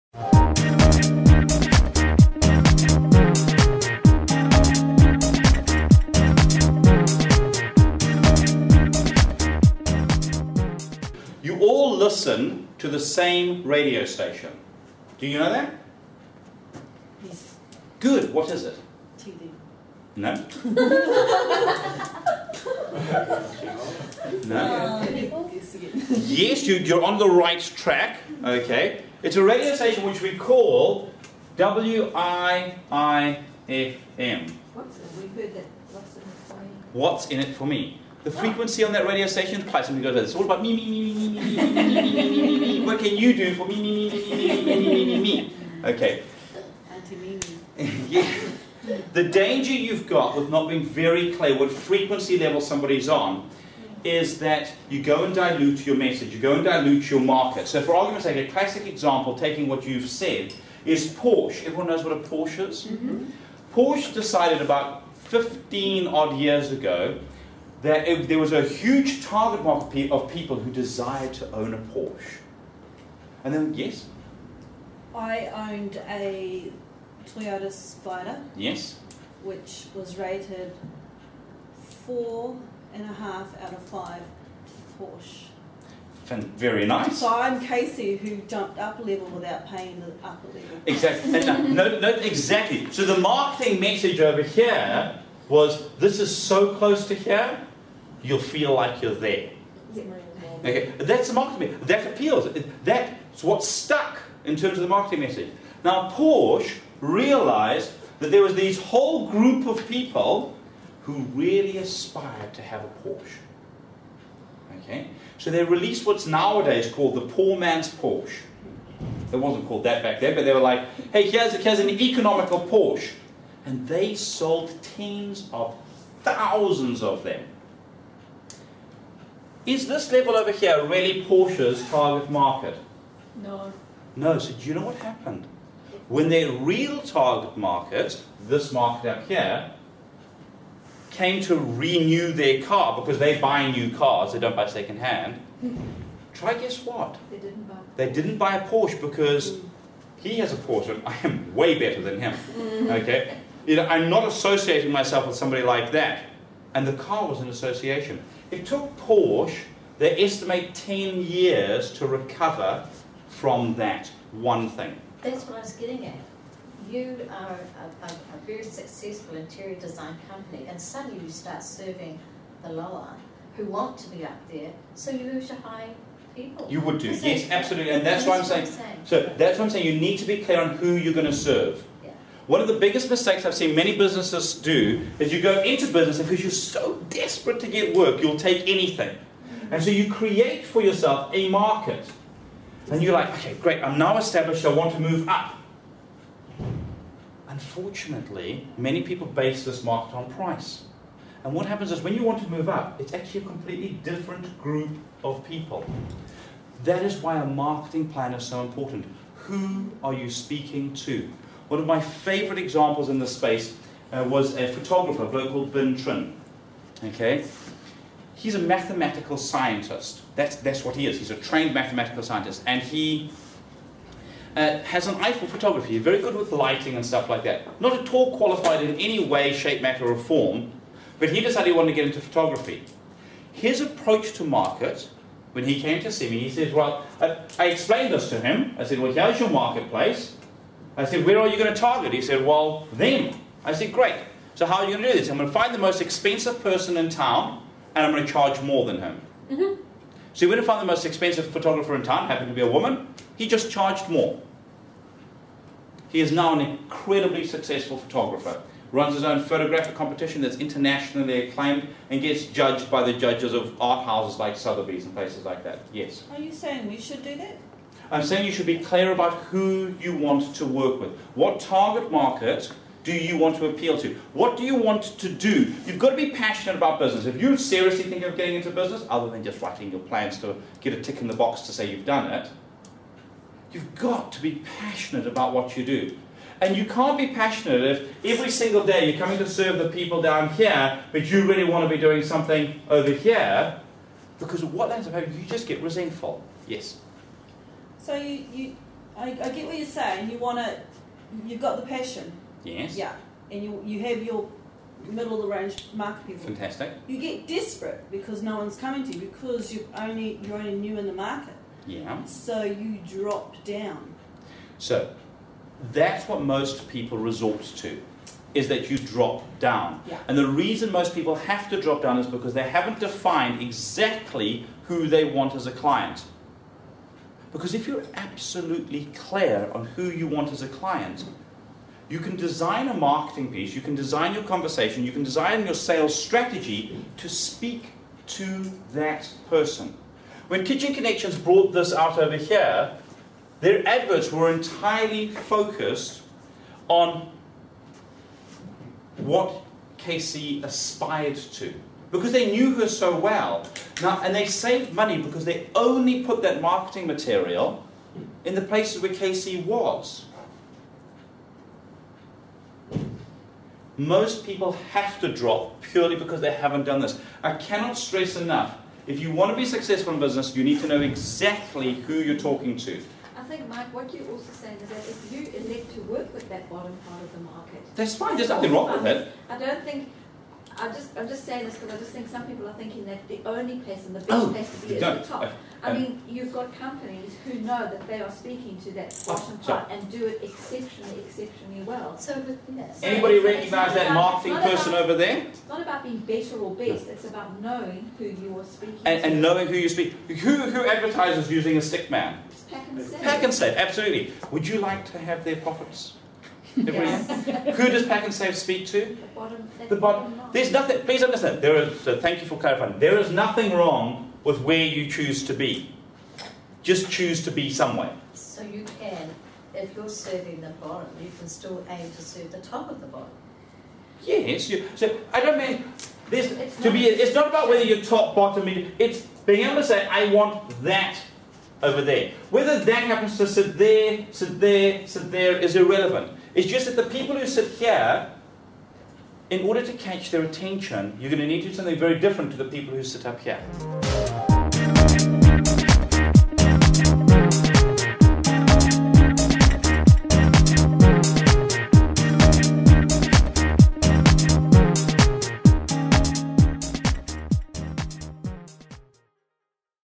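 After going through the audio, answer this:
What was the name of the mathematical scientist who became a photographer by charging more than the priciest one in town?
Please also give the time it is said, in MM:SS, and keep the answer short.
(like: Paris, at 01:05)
Vin Trin, at 03:35.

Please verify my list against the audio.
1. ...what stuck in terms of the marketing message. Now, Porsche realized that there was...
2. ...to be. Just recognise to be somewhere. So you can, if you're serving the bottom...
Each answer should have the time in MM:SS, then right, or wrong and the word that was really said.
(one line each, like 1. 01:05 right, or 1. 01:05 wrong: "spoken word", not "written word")
1. 01:43 right
2. 06:55 wrong: "choose", not "recognise".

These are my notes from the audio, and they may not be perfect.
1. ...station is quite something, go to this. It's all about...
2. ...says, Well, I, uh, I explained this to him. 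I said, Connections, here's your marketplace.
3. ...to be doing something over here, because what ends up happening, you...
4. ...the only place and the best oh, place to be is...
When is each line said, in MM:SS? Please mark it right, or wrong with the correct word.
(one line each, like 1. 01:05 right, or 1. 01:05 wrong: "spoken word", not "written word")
1. 00:39 right
2. 03:56 wrong: "Well", not "Connections"
3. 04:51 right
4. 06:23 right.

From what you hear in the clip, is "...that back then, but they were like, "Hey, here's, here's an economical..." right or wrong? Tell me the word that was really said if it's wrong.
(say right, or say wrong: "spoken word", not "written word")
right.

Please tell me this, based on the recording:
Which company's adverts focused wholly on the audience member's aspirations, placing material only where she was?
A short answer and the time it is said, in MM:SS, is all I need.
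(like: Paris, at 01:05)
Kitchen Connections, at 05:40.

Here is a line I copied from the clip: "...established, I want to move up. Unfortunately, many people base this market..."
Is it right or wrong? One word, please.
right.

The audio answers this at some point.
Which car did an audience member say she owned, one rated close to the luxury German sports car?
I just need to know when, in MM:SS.
01:17.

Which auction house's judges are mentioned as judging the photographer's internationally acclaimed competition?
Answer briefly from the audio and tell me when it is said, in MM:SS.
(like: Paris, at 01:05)
Sotheby's, at 04:24.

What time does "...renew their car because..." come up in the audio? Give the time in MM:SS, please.
02:21.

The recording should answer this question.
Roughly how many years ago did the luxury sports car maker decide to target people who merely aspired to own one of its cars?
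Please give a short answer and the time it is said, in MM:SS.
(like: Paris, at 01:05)
15, at 01:05.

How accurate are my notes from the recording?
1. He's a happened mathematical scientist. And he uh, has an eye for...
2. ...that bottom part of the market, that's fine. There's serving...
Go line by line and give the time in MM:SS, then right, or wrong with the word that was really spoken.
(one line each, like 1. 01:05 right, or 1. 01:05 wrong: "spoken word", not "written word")
1. 03:41 wrong: "trained", not "happened"
2. 06:16 wrong: "nothing", not "serving".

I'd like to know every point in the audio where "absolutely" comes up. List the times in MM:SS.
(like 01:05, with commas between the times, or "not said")
02:57, 05:28, 06:43.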